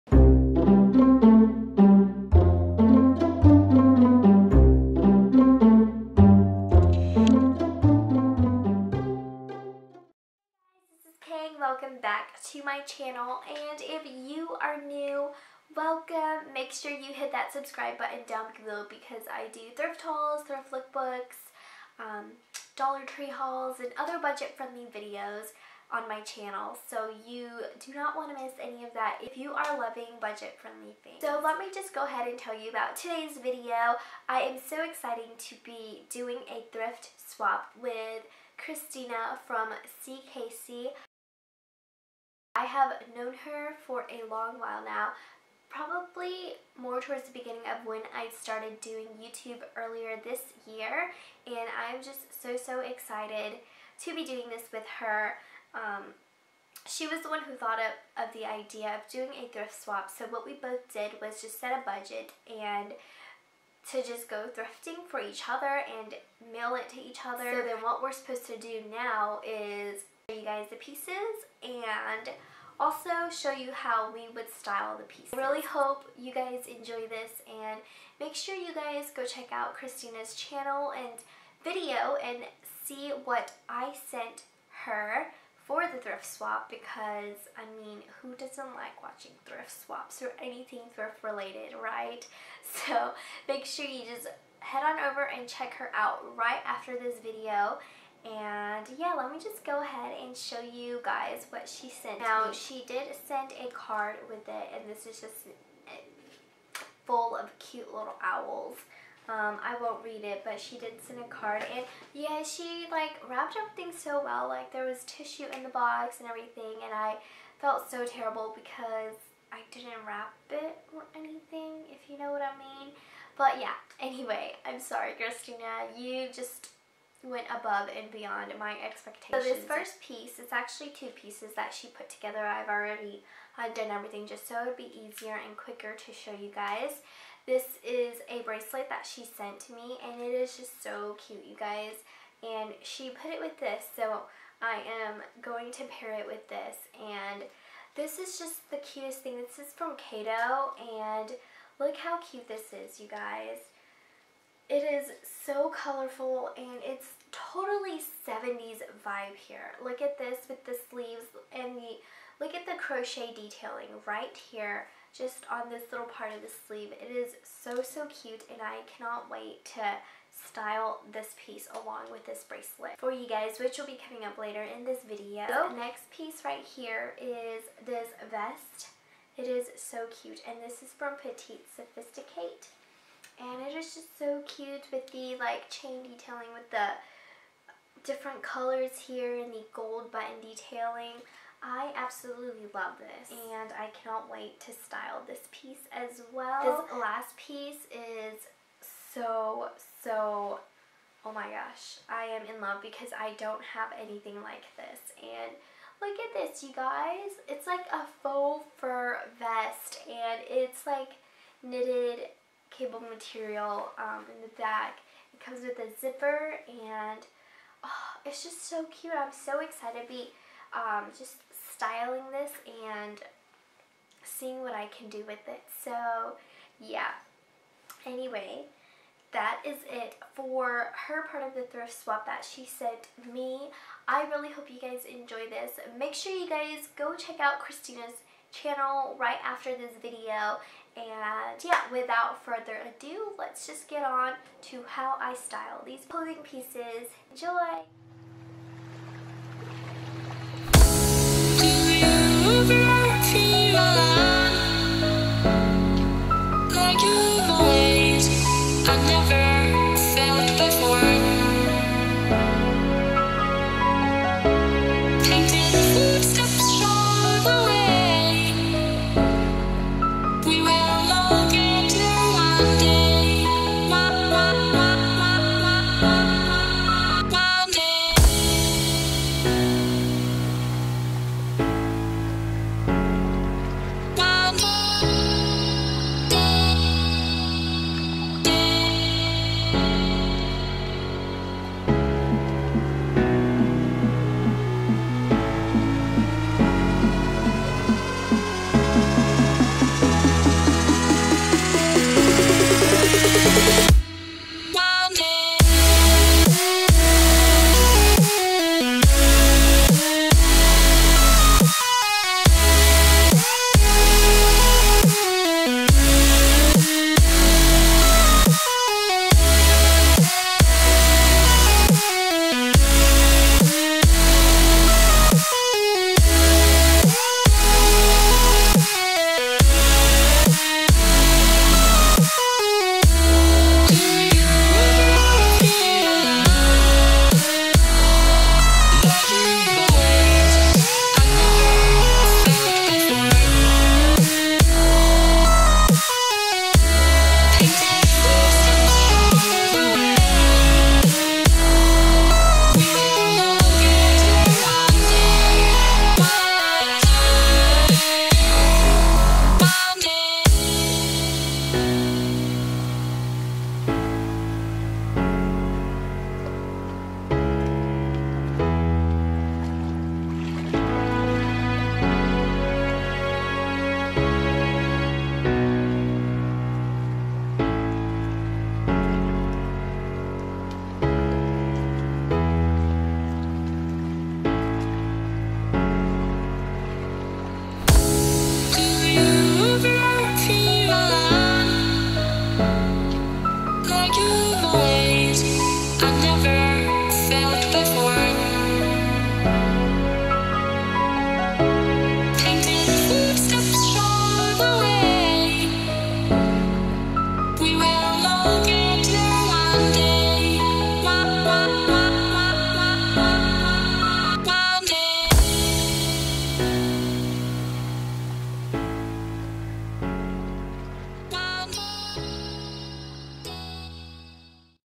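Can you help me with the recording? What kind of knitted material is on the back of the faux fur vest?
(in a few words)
Cable.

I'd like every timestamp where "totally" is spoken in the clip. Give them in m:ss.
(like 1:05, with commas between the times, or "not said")
2:37.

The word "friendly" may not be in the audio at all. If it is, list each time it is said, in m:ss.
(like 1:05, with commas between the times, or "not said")
0:24, 0:30.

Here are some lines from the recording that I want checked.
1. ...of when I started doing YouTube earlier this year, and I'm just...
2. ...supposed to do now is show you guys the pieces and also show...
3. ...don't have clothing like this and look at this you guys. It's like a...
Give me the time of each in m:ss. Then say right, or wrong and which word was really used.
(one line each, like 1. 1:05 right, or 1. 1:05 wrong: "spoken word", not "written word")
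1. 0:47 right
2. 1:08 right
3. 3:23 wrong: "anything", not "clothing".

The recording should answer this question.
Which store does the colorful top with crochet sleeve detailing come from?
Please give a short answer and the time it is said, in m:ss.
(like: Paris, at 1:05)
Cato, at 2:29.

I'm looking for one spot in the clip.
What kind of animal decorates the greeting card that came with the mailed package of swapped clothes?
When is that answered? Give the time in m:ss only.
1:48.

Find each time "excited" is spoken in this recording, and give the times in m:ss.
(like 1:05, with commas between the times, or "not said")
0:34, 0:52, 3:39.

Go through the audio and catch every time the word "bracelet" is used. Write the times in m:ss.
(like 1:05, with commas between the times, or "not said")
2:18, 2:52.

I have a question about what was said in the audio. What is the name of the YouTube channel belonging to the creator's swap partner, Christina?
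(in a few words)
seekaysee.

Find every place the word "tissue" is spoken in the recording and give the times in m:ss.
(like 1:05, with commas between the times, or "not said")
1:55.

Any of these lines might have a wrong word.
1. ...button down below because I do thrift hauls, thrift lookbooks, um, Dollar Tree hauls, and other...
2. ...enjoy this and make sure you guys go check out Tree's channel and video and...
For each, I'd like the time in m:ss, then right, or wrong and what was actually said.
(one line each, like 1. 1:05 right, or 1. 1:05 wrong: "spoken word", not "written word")
1. 0:17 right
2. 1:16 wrong: "Christina", not "Tree".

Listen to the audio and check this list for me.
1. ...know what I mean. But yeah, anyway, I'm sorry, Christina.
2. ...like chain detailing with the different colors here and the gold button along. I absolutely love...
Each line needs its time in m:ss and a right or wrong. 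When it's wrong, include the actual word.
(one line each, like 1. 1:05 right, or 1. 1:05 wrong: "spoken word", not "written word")
1. 2:02 right
2. 3:05 wrong: "detailing", not "along".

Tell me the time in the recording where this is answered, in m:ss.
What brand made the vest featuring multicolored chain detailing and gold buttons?
3:01.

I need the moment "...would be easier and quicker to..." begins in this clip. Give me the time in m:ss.
2:14.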